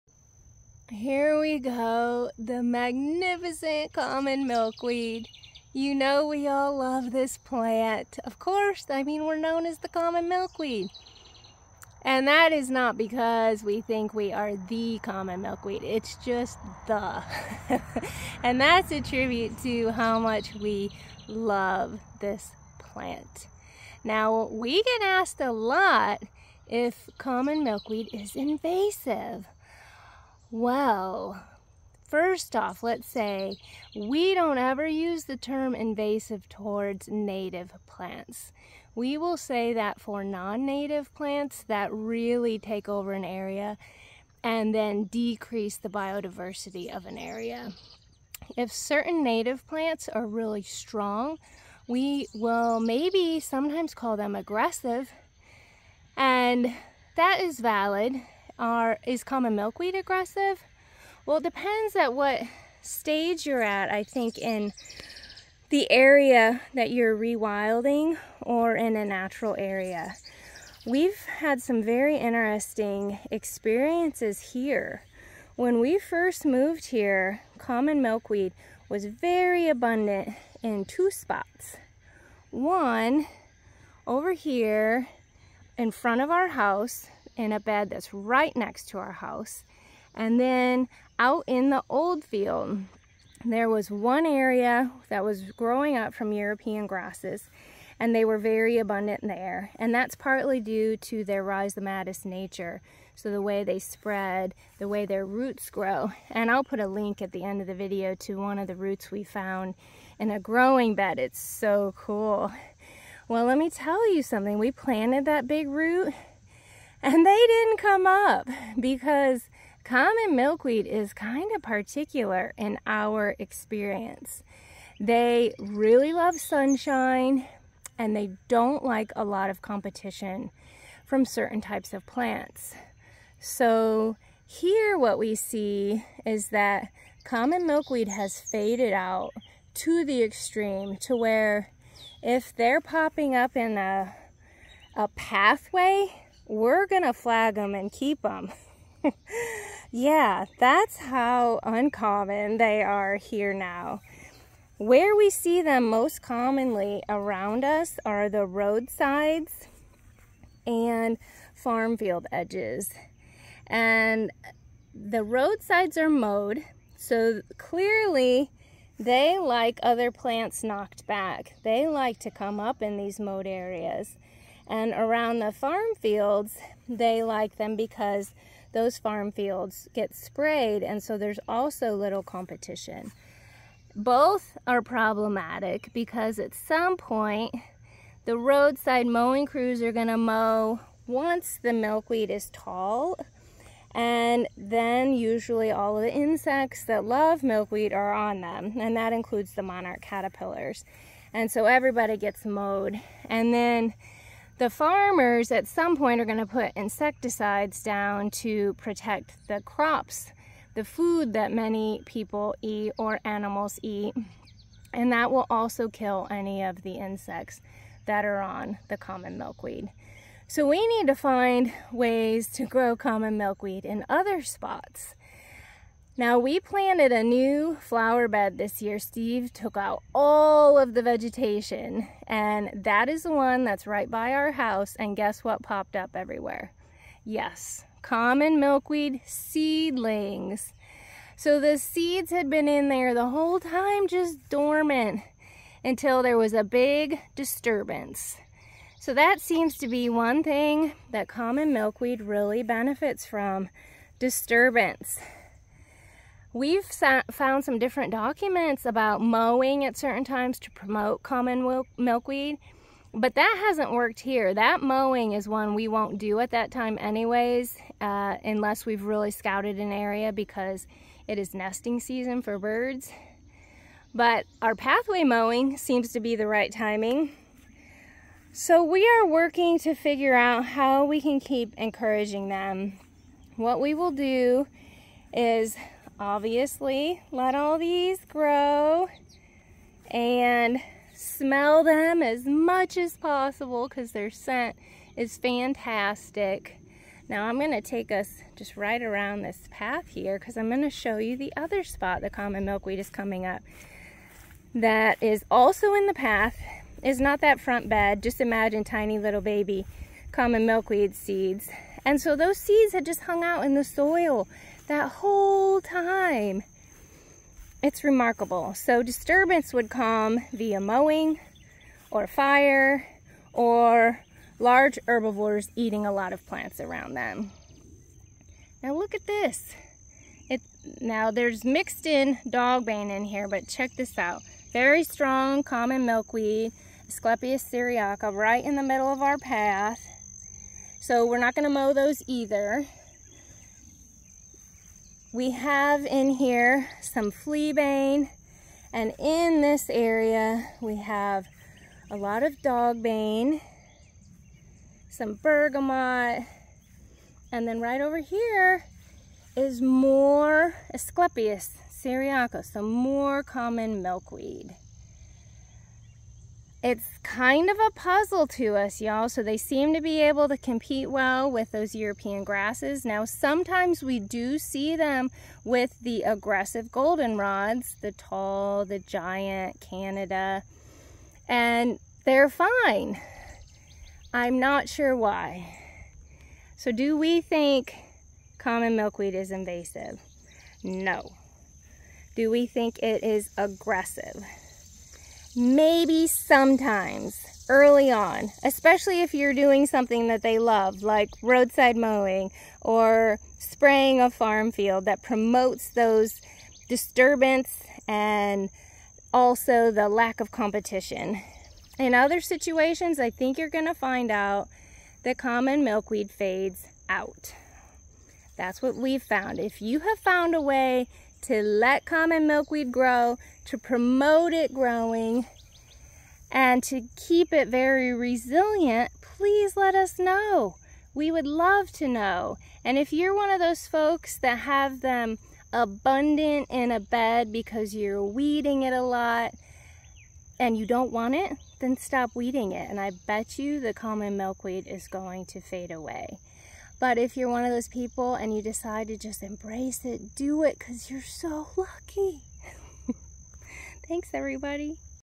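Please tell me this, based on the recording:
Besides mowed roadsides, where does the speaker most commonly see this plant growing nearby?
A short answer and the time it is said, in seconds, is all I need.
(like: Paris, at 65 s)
farm field edges, at 161 s.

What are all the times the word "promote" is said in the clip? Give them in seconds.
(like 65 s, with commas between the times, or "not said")
260 s, 405 s, 423 s.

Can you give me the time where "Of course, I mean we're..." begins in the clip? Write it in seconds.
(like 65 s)
8 s.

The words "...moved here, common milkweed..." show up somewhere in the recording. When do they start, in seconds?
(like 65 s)
76 s.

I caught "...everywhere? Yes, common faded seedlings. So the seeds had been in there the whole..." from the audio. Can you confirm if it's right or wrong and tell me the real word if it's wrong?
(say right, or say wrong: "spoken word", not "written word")
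wrong: "milkweed", not "faded".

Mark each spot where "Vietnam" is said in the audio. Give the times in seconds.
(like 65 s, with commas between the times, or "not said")
not said.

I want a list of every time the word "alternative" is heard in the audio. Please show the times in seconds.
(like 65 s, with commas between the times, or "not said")
not said.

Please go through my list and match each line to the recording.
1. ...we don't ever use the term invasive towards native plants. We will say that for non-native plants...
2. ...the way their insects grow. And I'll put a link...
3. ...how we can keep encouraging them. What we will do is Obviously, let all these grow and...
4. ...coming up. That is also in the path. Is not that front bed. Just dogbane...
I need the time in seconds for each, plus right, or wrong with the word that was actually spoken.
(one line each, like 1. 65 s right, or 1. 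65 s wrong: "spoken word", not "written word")
1. 33 s right
2. 104 s wrong: "roots", not "insects"
3. 280 s right
4. 303 s wrong: "imagine", not "dogbane".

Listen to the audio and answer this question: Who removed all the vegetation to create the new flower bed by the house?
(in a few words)
Steve.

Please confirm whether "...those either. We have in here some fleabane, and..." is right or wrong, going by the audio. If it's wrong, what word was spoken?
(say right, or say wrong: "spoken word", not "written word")
right.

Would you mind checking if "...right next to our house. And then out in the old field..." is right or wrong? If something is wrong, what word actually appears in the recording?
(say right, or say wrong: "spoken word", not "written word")
right.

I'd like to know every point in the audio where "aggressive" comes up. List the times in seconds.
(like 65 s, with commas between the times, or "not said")
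54 s, 59 s, 376 s, 393 s.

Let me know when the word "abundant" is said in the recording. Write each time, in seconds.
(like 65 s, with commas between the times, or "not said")
79 s, 98 s, 435 s.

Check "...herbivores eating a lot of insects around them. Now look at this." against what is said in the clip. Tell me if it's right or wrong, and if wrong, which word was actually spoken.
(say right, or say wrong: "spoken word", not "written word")
wrong: "plants", not "insects".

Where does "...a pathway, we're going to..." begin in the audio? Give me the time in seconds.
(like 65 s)
144 s.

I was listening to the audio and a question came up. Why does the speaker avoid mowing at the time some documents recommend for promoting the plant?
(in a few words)
nesting season for birds.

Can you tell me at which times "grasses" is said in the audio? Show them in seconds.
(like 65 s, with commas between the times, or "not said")
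96 s, 372 s.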